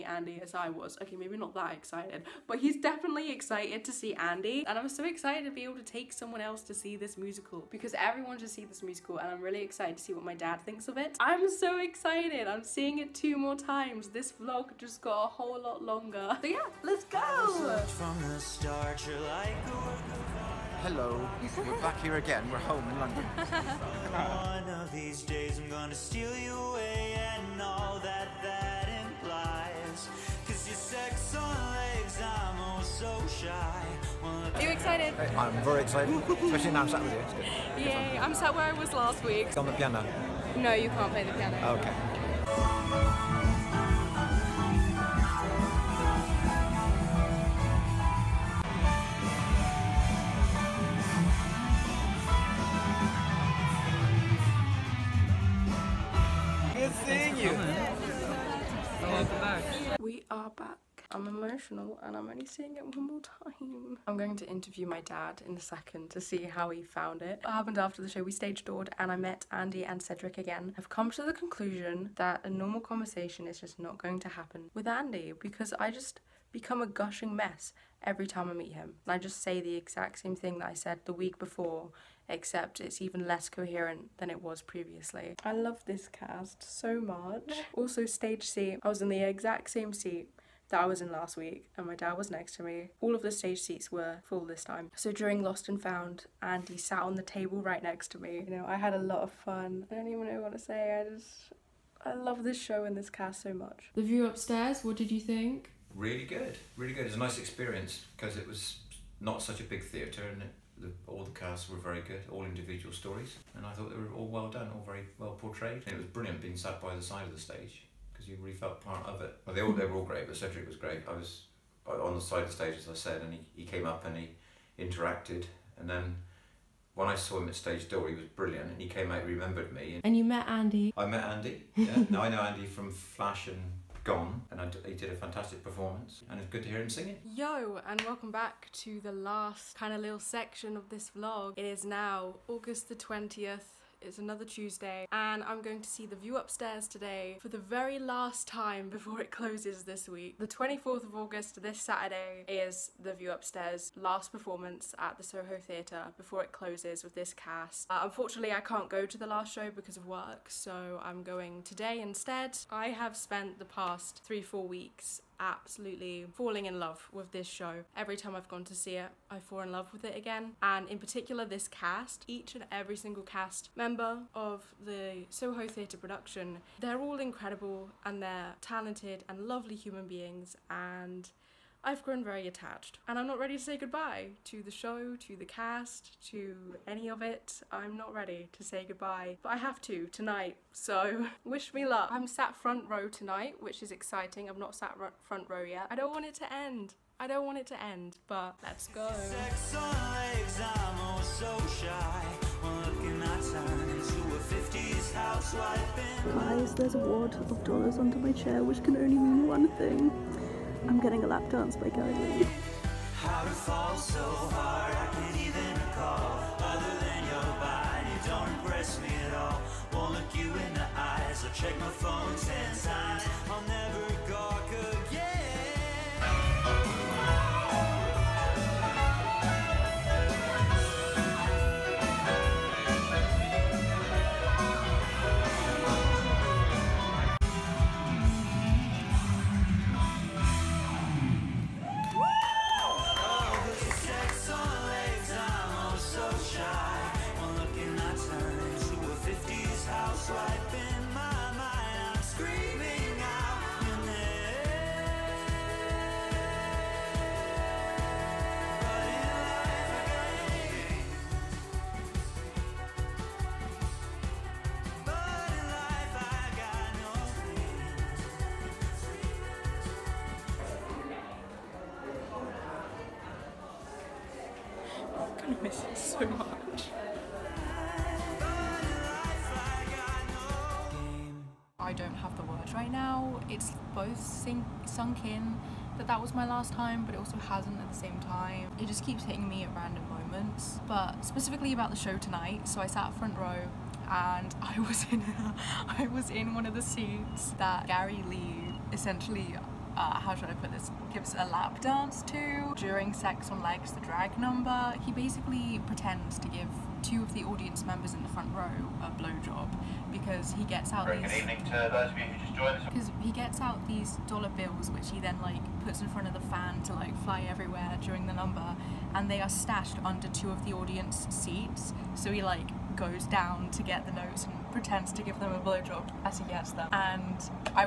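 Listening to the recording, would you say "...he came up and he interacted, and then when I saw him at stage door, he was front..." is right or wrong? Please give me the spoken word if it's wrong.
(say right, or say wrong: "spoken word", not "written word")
wrong: "brilliant", not "front".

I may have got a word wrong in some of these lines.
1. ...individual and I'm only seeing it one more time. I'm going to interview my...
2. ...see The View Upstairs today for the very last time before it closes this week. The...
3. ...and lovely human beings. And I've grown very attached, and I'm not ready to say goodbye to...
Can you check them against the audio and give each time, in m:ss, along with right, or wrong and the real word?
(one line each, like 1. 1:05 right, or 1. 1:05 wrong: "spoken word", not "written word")
1. 1:01 wrong: "emotional", not "individual"
2. 2:25 right
3. 2:59 right.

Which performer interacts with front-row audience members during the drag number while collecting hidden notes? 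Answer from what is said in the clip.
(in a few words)
Garry Lee.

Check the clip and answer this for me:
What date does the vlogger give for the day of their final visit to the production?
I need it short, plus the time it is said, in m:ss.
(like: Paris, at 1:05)
August 20, at 2:22.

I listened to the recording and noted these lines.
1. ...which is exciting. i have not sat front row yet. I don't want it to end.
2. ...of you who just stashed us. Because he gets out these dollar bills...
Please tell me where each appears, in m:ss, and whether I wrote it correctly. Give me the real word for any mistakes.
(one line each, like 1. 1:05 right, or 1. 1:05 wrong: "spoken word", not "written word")
1. 3:13 right
2. 5:12 wrong: "joined", not "stashed".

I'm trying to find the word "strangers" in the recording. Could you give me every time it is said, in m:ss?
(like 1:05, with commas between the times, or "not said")
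not said.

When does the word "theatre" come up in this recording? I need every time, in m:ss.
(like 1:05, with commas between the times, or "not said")
1:49, 2:35, 2:55.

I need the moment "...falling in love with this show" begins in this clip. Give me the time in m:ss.
2:46.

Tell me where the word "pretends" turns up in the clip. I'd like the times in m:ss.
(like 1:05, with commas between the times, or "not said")
5:05, 5:24.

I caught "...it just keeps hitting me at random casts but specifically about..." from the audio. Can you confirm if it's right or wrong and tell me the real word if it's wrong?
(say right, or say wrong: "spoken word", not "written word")
wrong: "moments", not "casts".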